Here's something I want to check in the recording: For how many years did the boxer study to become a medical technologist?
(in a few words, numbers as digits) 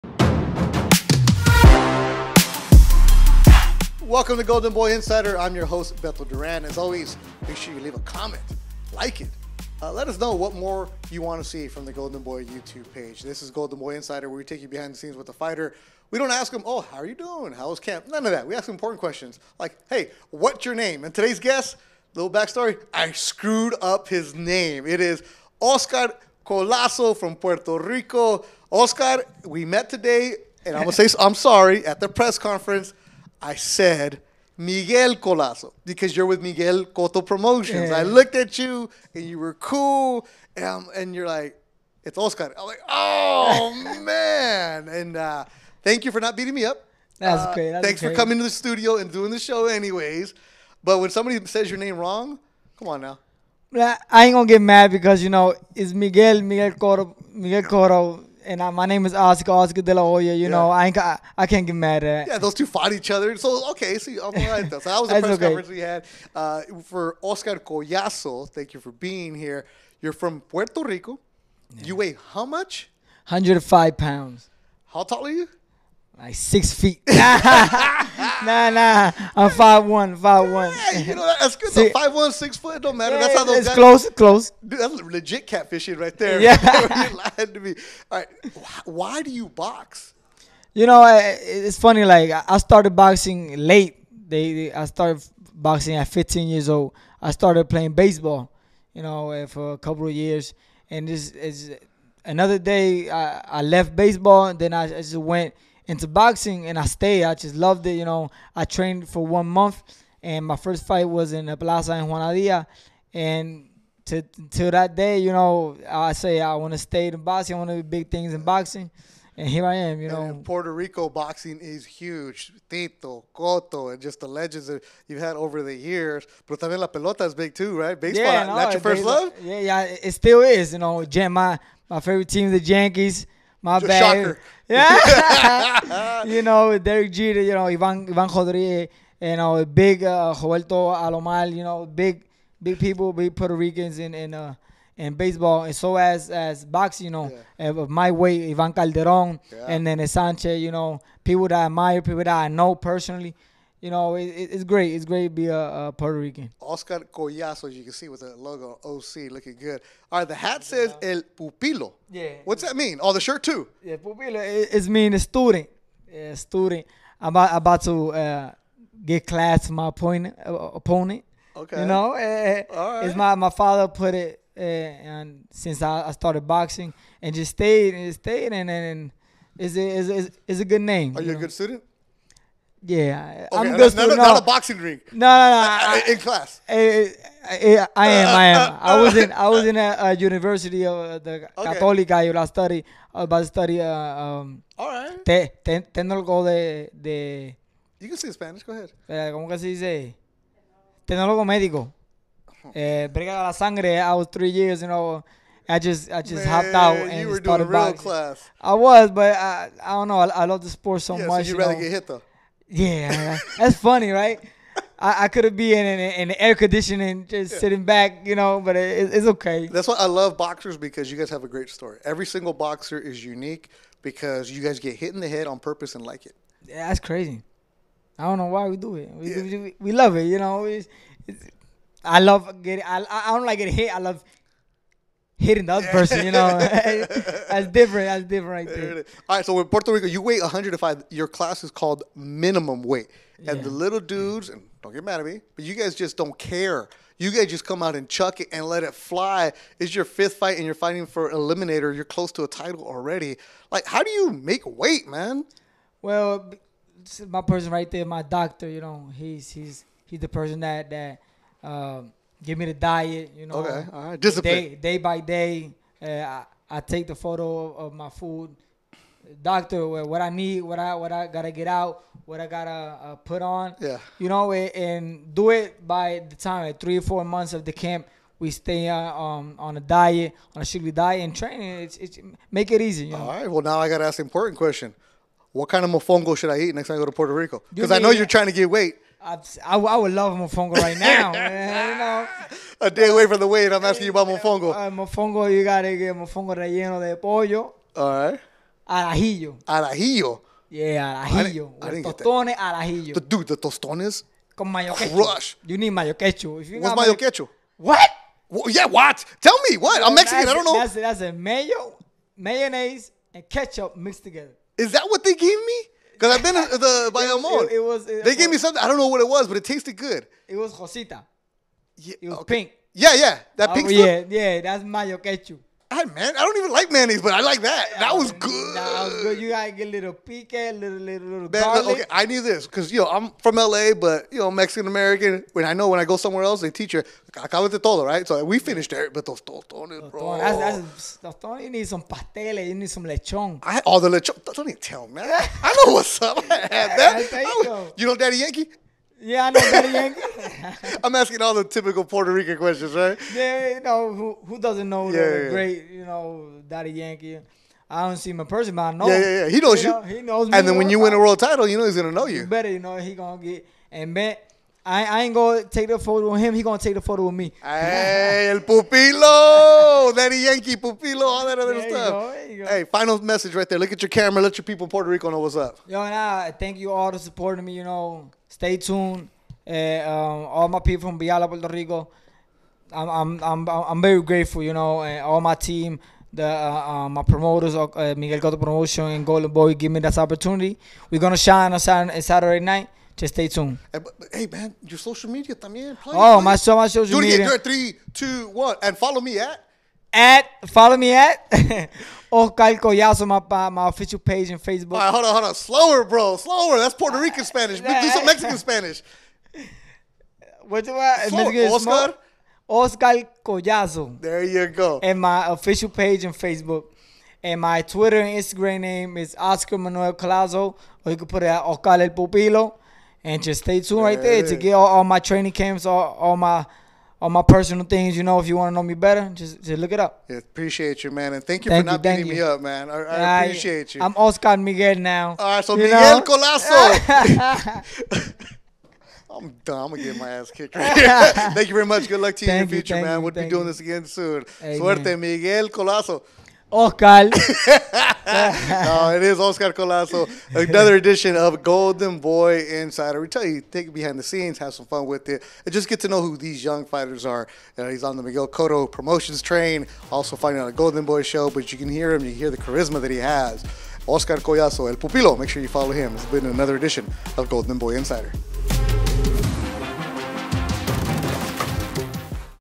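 3.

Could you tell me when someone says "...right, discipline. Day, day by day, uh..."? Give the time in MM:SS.
04:24.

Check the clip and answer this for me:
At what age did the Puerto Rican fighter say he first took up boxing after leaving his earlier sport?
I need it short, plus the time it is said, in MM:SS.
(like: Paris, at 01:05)
15, at 01:36.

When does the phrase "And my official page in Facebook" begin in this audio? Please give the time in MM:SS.
06:55.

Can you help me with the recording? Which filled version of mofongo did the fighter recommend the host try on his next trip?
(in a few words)
Mofongo relleno de pollo.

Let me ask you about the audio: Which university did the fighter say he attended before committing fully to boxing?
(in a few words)
Católica.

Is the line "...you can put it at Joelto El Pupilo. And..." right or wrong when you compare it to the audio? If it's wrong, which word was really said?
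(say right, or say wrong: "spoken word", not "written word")
wrong: "Oscar", not "Joelto".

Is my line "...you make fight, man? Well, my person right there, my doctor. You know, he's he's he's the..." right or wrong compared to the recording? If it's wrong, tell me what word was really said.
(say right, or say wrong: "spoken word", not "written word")
wrong: "weight", not "fight".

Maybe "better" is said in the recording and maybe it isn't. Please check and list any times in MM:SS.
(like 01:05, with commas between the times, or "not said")
06:02, 07:08.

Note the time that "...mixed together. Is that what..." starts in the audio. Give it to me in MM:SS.
05:13.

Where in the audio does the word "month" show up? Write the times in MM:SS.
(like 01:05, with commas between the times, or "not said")
01:49, 04:37.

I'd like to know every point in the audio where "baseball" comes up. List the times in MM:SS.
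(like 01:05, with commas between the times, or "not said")
01:37, 01:43, 02:07, 02:25.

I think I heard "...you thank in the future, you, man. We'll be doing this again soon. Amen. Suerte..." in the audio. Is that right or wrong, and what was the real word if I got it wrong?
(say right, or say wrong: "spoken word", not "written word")
right.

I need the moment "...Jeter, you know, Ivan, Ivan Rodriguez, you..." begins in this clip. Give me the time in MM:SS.
02:17.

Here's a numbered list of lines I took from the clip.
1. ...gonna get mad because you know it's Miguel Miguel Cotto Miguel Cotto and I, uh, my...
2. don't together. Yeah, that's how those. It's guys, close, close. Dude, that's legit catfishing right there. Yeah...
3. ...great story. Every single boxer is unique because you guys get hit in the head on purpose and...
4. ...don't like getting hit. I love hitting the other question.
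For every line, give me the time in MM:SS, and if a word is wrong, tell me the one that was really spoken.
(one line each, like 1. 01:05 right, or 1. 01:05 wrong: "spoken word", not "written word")
1. 00:54 right
2. 01:22 wrong: "matter", not "together"
3. 03:41 right
4. 03:53 wrong: "person", not "question".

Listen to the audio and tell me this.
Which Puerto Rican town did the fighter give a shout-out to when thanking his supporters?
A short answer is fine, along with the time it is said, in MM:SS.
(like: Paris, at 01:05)
Villalba, at 06:21.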